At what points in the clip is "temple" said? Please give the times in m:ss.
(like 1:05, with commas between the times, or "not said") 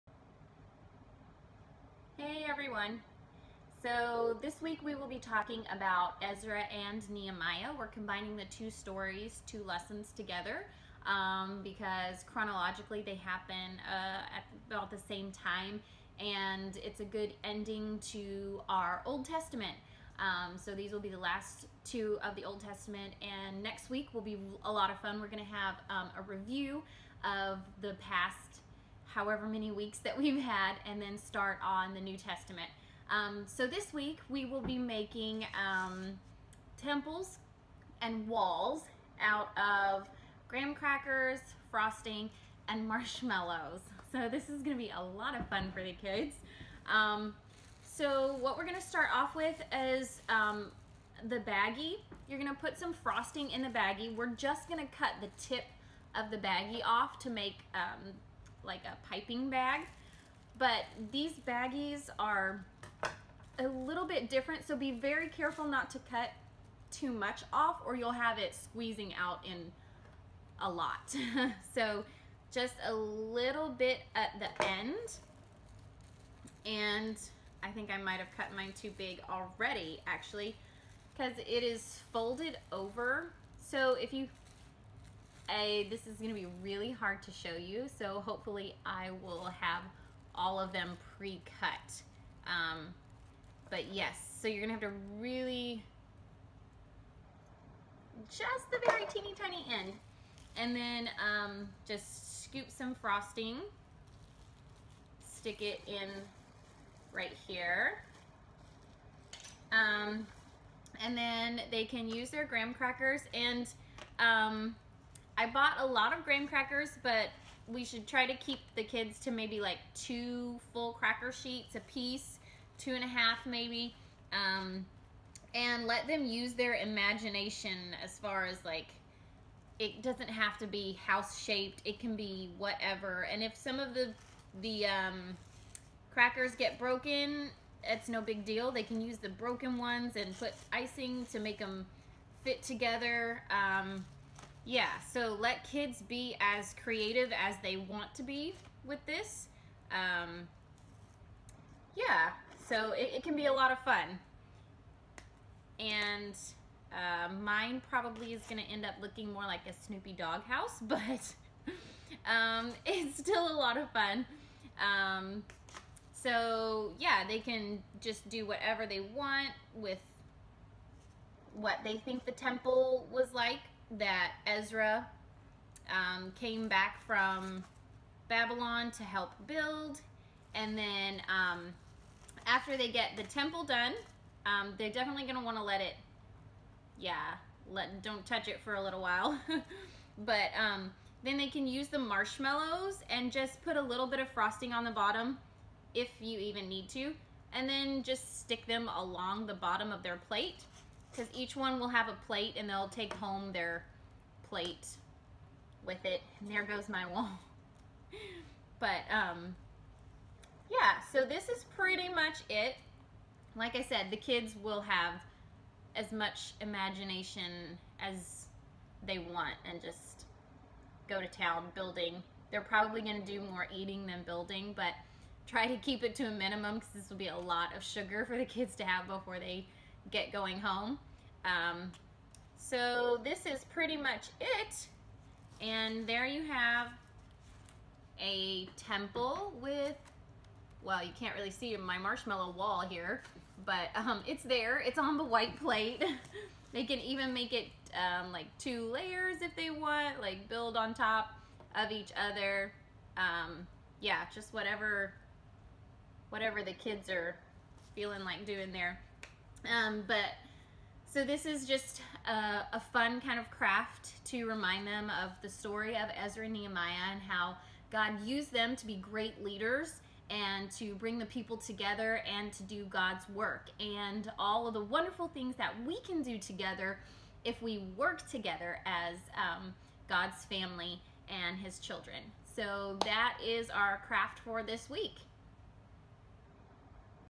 0:36, 2:52, 3:03, 3:58.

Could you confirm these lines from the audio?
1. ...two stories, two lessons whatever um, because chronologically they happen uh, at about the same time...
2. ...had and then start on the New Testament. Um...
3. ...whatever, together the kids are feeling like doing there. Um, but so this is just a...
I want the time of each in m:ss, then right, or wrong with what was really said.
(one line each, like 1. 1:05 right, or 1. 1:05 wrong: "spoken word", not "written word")
1. 0:08 wrong: "together", not "whatever"
2. 0:30 right
3. 4:14 wrong: "whatever", not "together".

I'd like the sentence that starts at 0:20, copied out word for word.
Um, so these will be the last two of the Old Testament and next week will be a lot of fun.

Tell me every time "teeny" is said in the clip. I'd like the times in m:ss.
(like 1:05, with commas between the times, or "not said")
1:39.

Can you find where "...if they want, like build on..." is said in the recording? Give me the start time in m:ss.
4:09.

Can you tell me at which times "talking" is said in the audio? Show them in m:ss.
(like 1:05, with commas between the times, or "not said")
0:05.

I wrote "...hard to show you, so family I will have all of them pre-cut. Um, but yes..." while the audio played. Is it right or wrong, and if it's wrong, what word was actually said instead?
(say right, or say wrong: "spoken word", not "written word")
wrong: "hopefully", not "family".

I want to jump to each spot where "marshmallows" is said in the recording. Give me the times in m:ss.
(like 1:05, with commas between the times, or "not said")
0:42, 3:11, 4:01.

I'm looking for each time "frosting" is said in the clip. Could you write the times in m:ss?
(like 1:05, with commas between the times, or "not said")
0:41, 0:52, 1:42, 3:14.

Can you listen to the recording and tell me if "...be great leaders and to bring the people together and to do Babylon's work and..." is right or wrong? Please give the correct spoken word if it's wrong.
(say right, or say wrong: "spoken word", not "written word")
wrong: "God", not "Babylon".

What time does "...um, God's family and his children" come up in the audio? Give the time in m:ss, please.
4:39.